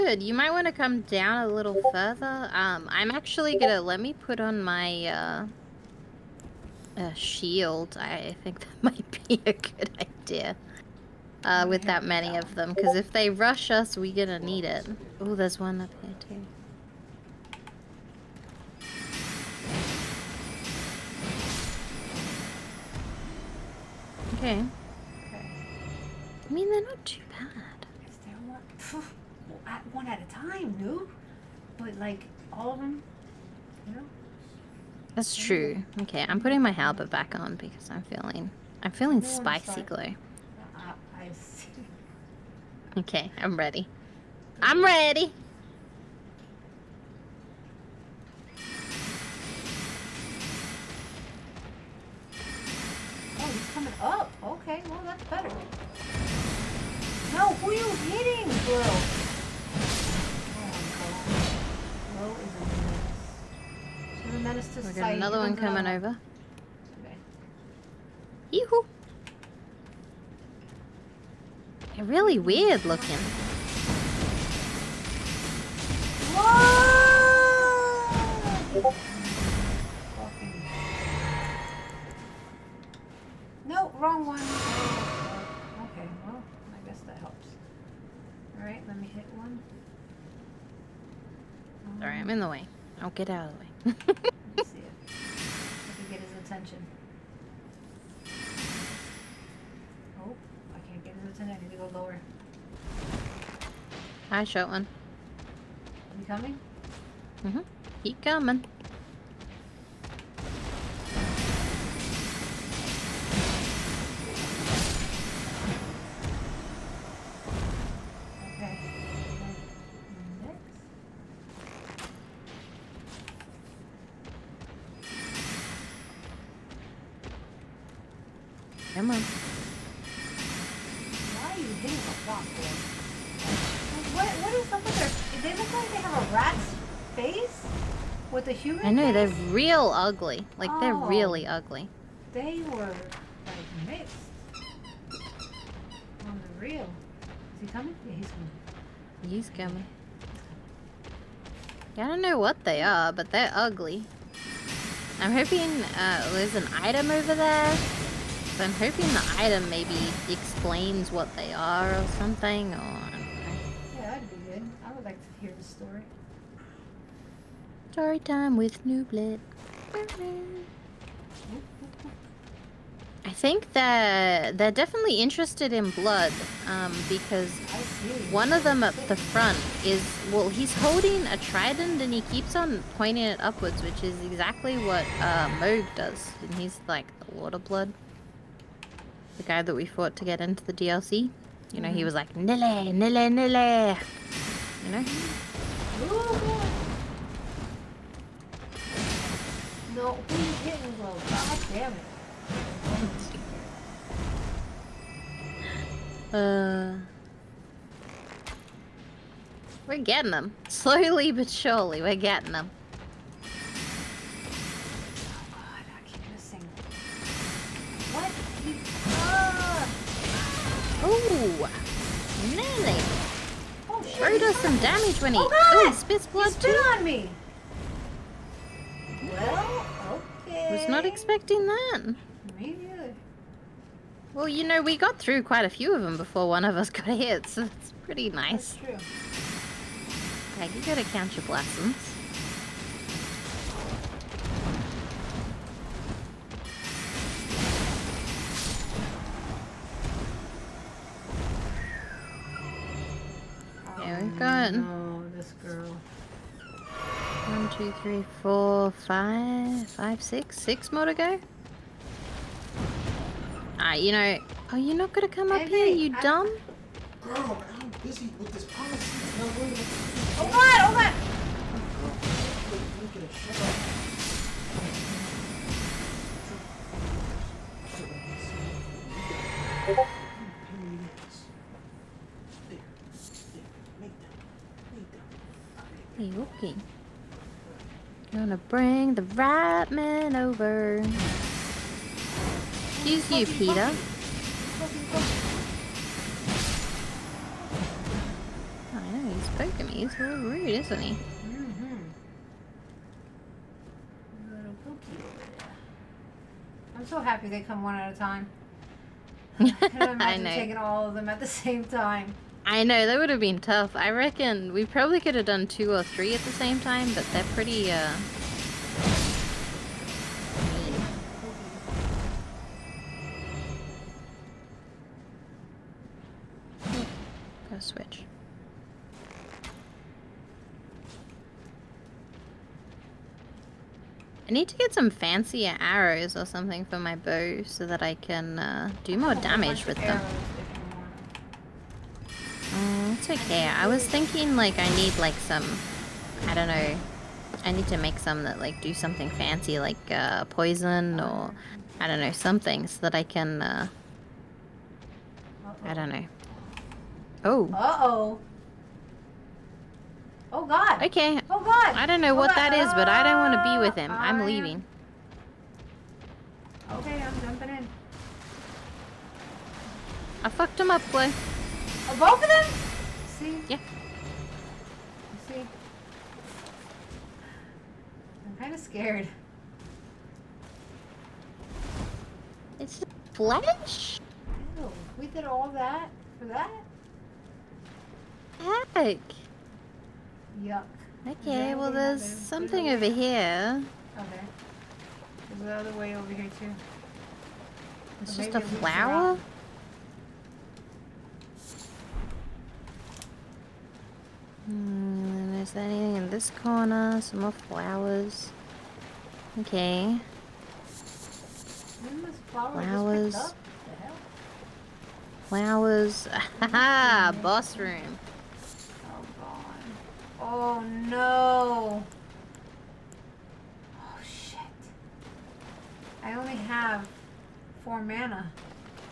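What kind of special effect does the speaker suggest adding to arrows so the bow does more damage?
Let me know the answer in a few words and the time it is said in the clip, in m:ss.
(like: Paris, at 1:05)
Poison, at 5:50.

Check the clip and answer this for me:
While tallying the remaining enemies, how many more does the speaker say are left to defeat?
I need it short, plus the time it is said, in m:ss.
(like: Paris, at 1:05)
6, at 4:20.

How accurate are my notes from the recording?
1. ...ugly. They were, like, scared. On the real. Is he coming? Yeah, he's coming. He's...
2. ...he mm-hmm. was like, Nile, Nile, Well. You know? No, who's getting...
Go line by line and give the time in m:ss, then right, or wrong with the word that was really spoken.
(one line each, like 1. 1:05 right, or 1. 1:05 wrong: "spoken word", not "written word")
1. 2:21 wrong: "mixed", not "scared"
2. 3:11 wrong: "Nile", not "Well".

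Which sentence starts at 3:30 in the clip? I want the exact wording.
Slowly but surely, we're getting them.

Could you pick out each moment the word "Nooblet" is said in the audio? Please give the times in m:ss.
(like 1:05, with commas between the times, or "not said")
2:48.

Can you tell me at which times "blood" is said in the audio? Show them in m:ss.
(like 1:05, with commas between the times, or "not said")
2:55, 3:07, 3:46.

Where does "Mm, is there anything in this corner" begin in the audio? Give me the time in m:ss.
6:44.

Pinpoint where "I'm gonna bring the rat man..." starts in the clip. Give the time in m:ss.
4:48.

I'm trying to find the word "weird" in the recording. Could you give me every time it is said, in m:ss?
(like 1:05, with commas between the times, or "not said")
1:12.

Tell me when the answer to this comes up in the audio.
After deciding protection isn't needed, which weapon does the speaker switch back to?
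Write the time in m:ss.
0:36.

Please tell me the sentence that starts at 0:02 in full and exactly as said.
Um, I'm actually gonna let me put on my uh, uh shield.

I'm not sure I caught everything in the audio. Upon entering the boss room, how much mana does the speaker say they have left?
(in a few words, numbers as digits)
4.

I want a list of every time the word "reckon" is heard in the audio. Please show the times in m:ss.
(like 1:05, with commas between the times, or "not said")
5:14.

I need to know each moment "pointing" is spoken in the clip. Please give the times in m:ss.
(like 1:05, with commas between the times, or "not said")
3:02.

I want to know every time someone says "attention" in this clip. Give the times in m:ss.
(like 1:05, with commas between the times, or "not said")
1:36, 1:41.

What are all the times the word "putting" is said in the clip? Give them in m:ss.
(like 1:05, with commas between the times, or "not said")
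0:36.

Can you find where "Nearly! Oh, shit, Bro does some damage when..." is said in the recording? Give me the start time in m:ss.
3:42.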